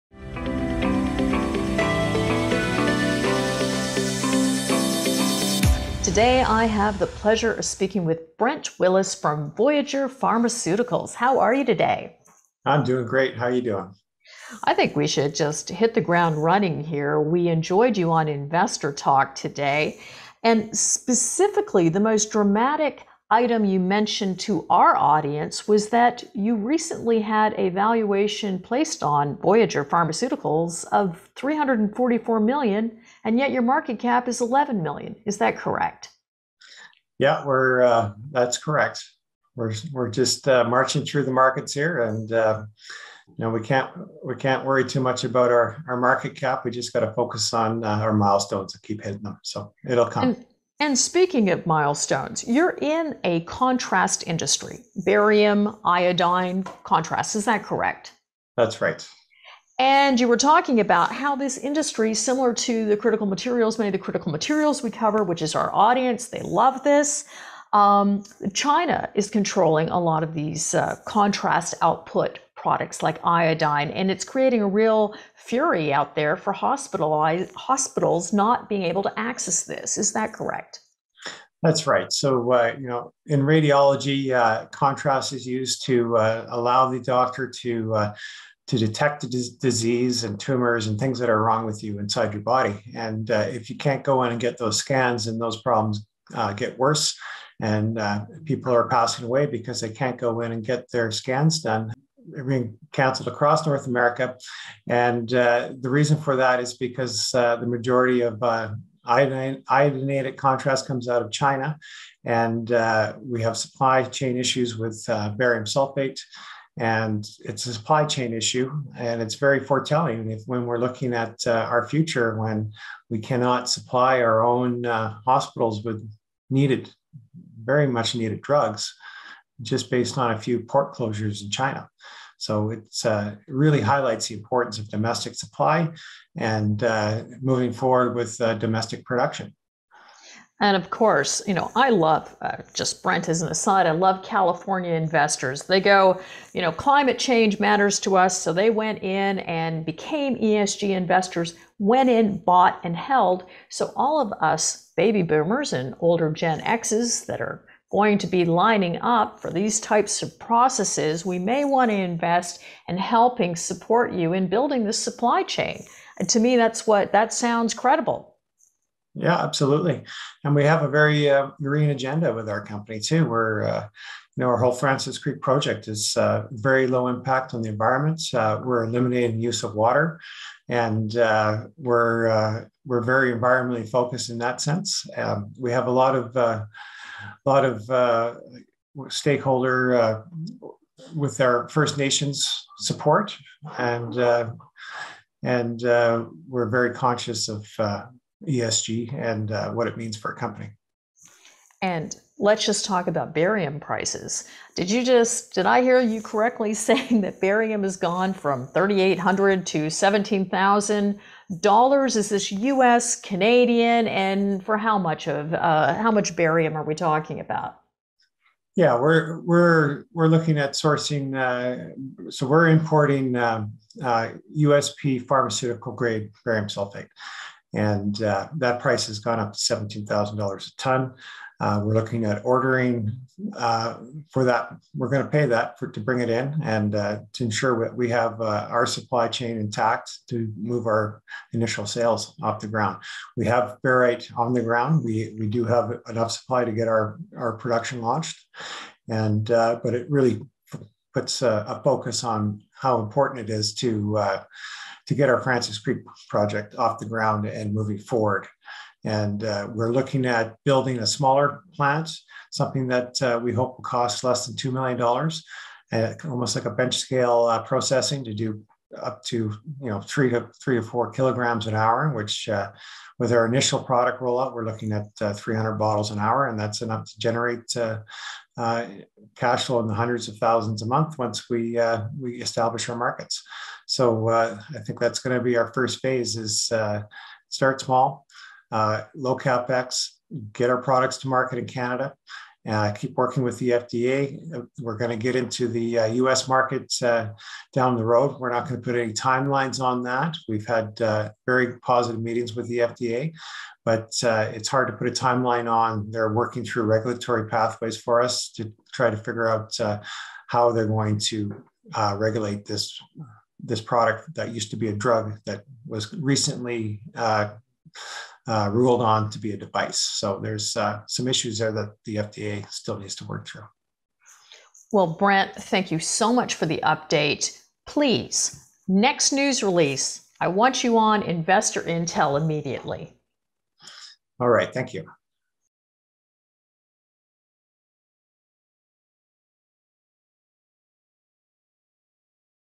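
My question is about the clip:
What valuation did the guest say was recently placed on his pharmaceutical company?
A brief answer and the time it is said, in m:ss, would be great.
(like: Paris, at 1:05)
344 million, at 0:31.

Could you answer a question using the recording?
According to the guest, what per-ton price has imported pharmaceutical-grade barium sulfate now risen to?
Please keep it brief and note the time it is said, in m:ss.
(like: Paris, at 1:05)
$17,000, at 3:49.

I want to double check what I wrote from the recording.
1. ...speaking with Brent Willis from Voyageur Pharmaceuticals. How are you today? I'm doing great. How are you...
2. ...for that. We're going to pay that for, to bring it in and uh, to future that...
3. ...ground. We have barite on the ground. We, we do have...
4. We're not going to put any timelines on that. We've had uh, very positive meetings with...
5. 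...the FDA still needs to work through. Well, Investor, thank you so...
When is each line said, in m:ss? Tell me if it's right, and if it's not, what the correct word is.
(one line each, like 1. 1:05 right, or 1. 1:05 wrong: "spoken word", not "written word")
1. 0:07 right
2. 3:54 wrong: "ensure", not "future"
3. 4:02 right
4. 4:58 right
5. 5:22 wrong: "Brent", not "Investor".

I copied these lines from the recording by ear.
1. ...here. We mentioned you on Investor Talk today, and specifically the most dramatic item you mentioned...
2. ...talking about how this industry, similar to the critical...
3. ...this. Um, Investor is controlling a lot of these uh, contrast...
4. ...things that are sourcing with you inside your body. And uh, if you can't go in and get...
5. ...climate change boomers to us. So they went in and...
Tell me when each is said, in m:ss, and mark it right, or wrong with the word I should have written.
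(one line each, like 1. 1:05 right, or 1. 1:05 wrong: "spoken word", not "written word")
1. 0:16 wrong: "enjoyed", not "mentioned"
2. 1:00 right
3. 1:06 wrong: "China", not "Investor"
4. 1:30 wrong: "wrong", not "sourcing"
5. 2:26 wrong: "matters", not "boomers".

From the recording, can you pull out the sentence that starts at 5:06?
They're working through regulatory pathways for us to try to figure out how they're going to regulate this.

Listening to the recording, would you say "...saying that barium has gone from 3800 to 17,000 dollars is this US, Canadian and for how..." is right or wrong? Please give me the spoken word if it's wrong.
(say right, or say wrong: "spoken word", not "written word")
right.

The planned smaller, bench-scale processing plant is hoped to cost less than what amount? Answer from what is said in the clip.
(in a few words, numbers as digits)
$2 million.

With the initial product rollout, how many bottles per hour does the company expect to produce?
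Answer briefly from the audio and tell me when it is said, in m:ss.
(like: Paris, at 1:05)
300, at 4:35.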